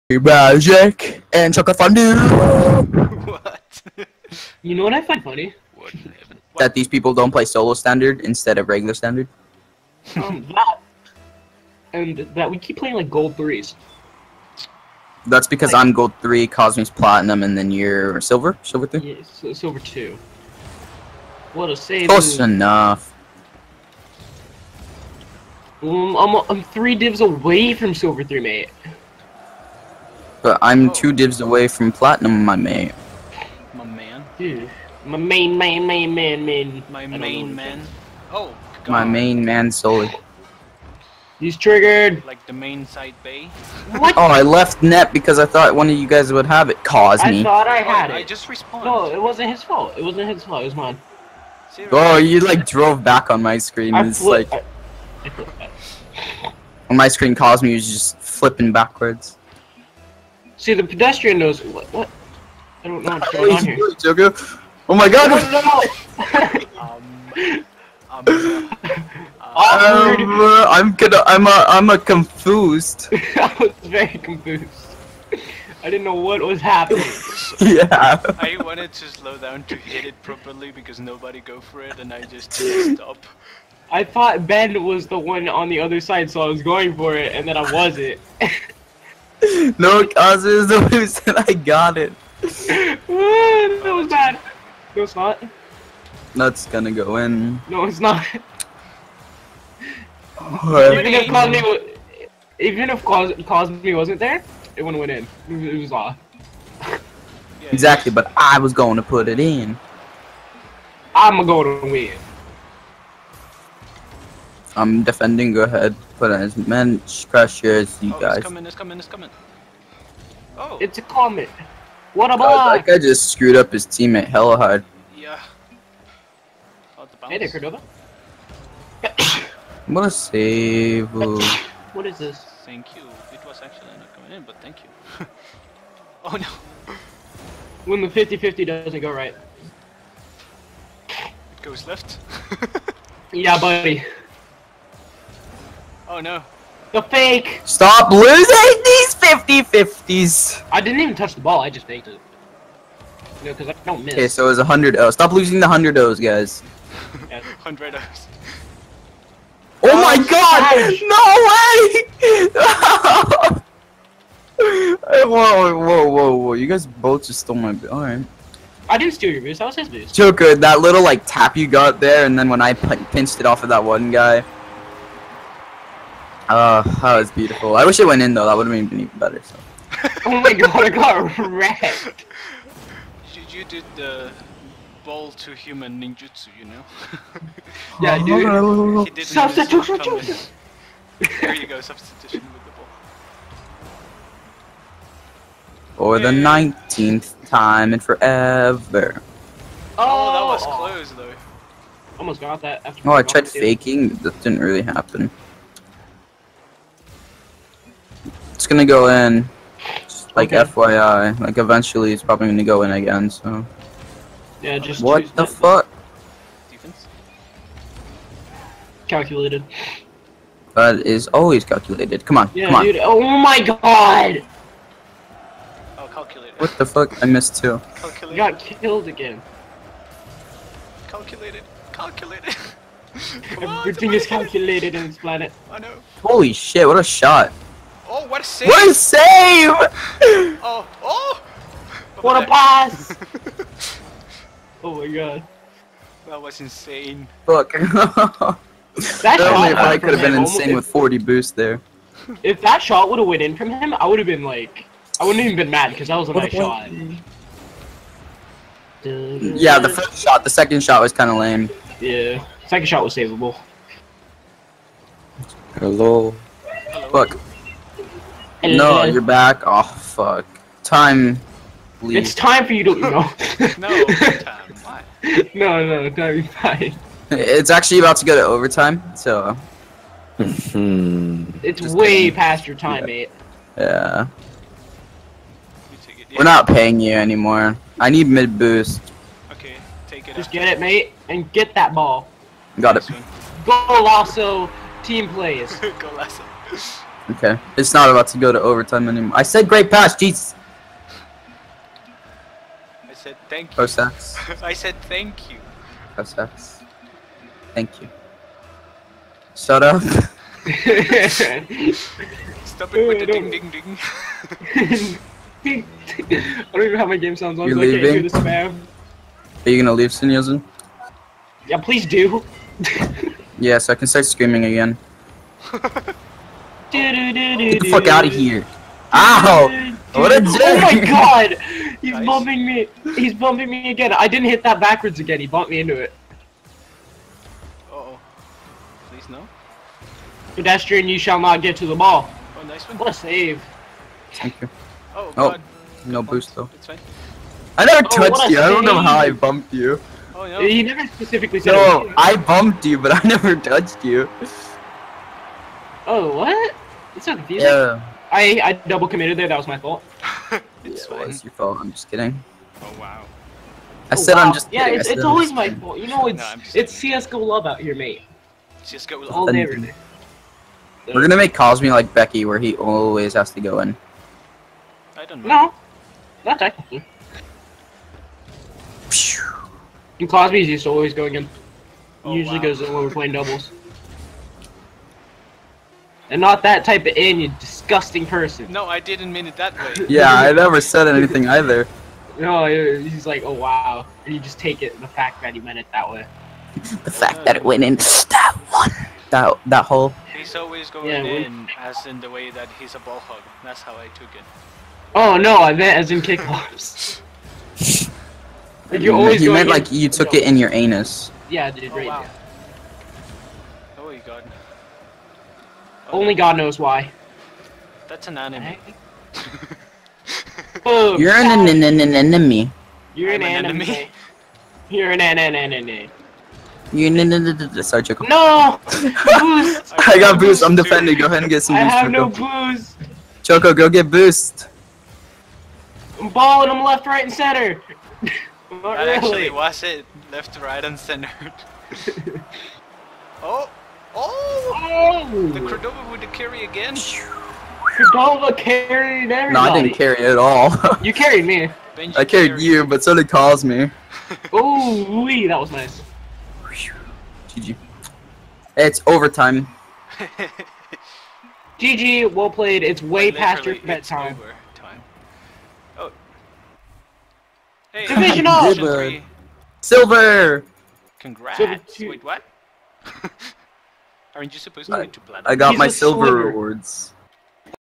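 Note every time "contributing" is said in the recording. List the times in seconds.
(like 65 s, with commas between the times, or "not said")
not said.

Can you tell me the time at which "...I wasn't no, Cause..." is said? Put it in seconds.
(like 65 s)
87 s.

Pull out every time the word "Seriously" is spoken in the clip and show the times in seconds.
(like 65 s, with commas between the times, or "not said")
51 s.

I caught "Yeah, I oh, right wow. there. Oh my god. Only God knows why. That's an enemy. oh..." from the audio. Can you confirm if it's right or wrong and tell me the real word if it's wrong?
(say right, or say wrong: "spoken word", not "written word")
right.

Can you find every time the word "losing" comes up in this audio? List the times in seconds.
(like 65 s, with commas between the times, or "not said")
148 s, 155 s.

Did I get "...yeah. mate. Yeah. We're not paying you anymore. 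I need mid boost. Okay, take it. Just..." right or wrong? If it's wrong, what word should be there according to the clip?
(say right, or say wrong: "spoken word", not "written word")
right.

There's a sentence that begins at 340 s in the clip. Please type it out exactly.
Pedestrian, you shall not get to the ball.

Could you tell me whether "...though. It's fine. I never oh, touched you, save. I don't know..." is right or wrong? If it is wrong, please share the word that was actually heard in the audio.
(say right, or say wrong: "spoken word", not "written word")
right.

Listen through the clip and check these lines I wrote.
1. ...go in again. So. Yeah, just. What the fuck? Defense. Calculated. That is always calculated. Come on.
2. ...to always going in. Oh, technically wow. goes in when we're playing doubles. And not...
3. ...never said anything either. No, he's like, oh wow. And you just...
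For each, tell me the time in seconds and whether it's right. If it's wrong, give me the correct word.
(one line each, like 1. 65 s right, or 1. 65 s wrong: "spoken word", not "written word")
1. 212 s right
2. 380 s wrong: "usually", not "technically"
3. 390 s right.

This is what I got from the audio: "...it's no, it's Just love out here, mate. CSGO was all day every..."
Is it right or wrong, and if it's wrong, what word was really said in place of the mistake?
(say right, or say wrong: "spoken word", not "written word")
wrong: "CSGO", not "Just".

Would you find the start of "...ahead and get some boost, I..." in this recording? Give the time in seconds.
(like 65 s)
431 s.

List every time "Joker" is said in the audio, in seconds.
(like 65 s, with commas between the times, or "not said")
63 s, 170 s.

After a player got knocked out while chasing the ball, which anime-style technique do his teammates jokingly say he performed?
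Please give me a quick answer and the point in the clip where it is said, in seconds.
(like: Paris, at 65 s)
Ball to human ninjutsu, at 185 s.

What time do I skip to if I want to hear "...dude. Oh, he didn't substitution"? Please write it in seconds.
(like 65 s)
188 s.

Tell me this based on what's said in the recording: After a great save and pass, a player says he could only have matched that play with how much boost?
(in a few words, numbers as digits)
40.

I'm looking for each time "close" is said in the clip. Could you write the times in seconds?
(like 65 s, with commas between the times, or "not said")
22 s, 200 s.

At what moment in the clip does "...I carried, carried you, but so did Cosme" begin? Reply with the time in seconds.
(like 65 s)
452 s.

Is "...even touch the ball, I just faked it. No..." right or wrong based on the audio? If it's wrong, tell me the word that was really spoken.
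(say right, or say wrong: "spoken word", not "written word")
right.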